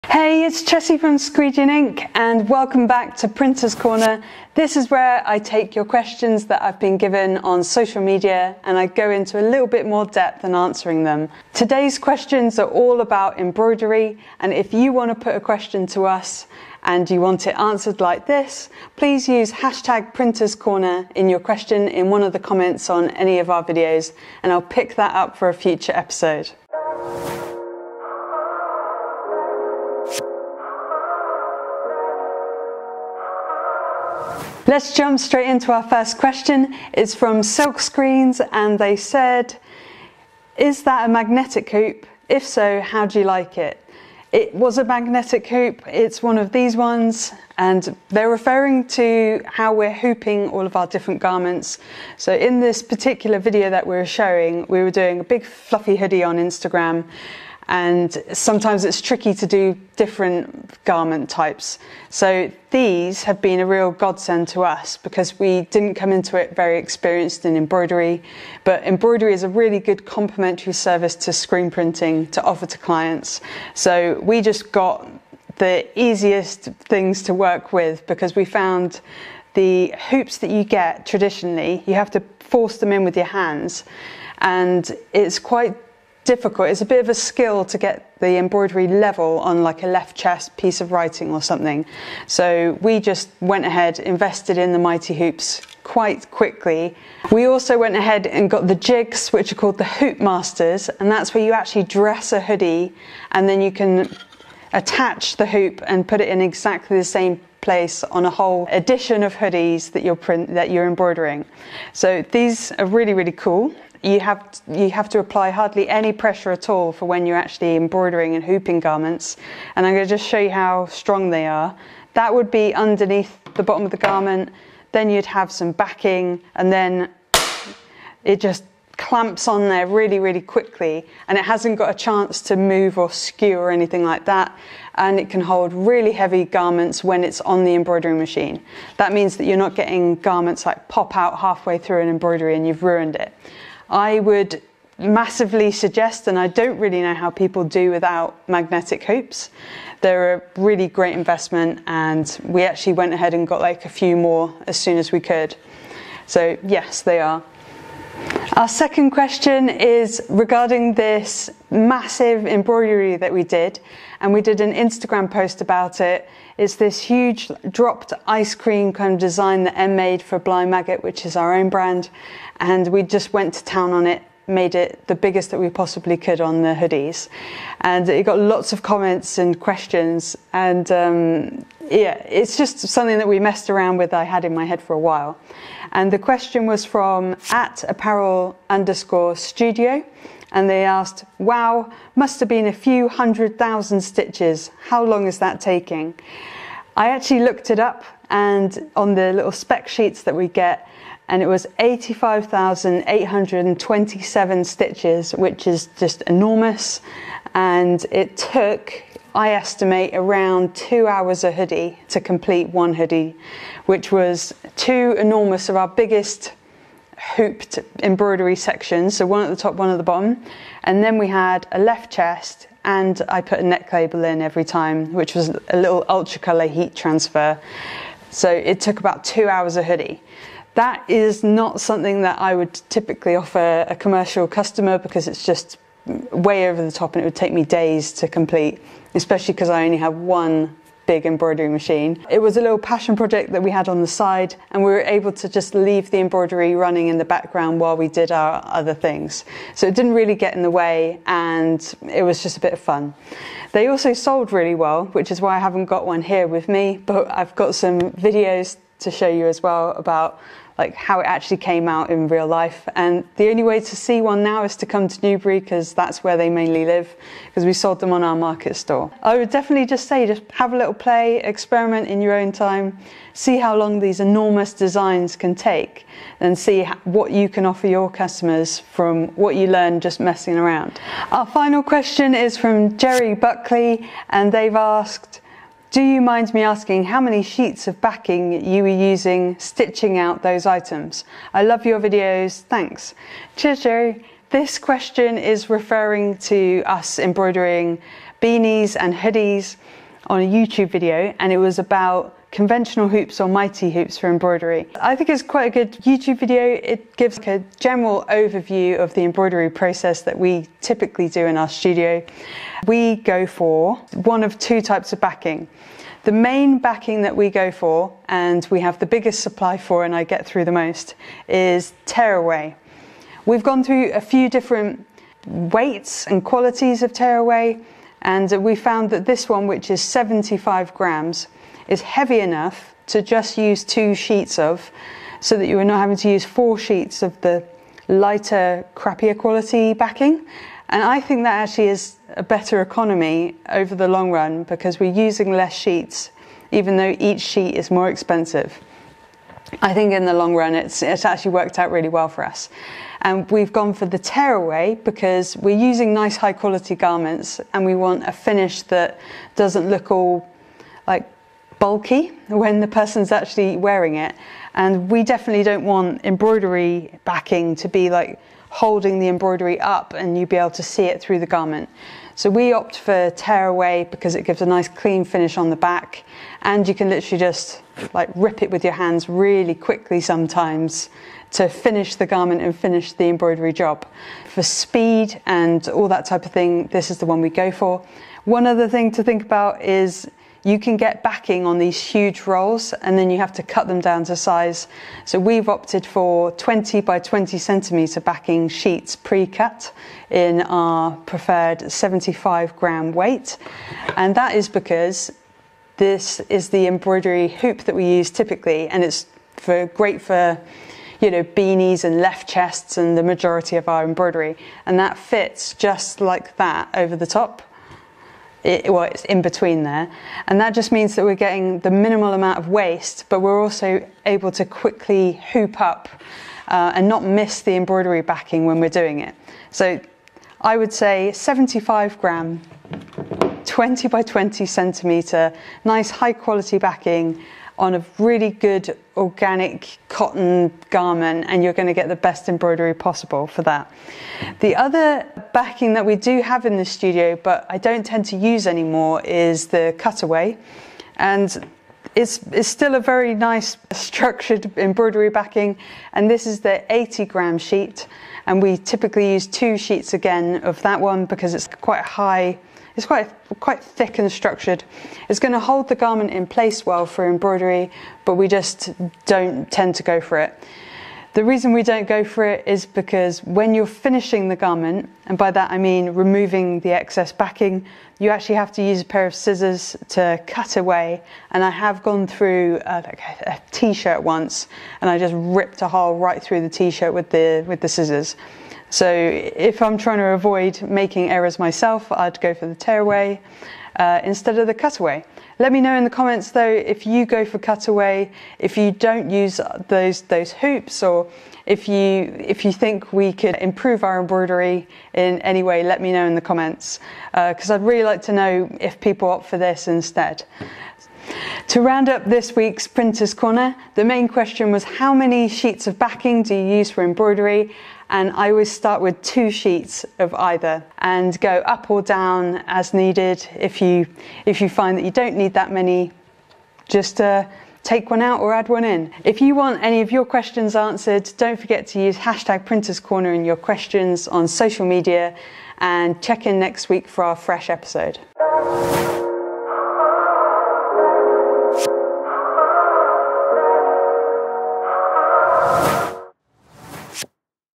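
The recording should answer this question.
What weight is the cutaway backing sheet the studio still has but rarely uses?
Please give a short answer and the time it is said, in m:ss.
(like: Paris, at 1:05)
80 grams, at 7:36.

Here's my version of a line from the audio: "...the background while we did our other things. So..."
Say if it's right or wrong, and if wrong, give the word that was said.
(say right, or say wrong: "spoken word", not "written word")
right.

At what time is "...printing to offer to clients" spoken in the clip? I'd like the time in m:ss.
1:11.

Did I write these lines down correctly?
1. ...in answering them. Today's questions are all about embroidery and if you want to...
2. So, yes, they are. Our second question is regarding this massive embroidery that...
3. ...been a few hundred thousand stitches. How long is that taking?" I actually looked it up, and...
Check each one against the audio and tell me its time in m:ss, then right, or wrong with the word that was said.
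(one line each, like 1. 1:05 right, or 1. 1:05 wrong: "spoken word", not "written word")
1. 0:10 right
2. 2:36 right
3. 3:12 right.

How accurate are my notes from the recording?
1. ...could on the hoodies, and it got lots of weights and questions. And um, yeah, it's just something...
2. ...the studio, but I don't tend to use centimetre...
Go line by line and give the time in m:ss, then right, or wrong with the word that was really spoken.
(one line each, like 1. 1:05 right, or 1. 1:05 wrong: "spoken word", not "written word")
1. 2:56 wrong: "comments", not "weights"
2. 7:26 wrong: "anymore", not "centimetre".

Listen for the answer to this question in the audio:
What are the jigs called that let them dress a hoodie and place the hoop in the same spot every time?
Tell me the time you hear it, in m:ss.
1:39.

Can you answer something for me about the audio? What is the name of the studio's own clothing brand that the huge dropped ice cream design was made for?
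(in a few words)
Blind Maggot.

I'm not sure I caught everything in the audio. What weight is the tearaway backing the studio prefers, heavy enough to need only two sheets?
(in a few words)
75 grams.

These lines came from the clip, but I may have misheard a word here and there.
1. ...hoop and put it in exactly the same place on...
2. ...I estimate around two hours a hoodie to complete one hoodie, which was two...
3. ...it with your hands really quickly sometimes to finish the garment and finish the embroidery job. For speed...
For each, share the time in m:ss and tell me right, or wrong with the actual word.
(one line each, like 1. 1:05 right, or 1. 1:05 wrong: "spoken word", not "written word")
1. 1:45 right
2. 3:29 right
3. 6:18 right.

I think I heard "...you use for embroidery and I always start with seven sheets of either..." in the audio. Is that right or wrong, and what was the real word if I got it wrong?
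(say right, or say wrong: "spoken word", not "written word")
wrong: "two", not "seven".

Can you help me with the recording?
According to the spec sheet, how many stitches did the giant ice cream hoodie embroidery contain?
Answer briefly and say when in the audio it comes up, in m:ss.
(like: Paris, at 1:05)
85,827, at 3:21.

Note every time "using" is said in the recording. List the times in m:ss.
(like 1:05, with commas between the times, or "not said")
4:49, 5:45, 5:55.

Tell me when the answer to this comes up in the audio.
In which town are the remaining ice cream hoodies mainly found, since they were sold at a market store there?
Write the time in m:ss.
4:25.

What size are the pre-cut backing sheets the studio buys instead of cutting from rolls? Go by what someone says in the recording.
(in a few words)
20 by 20 centimetres.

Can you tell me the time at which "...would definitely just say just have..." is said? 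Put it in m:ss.
4:29.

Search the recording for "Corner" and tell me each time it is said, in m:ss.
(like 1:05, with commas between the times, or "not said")
0:03, 0:20, 8:33, 8:52.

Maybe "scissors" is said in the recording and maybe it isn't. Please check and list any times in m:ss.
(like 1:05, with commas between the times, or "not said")
7:59, 8:07.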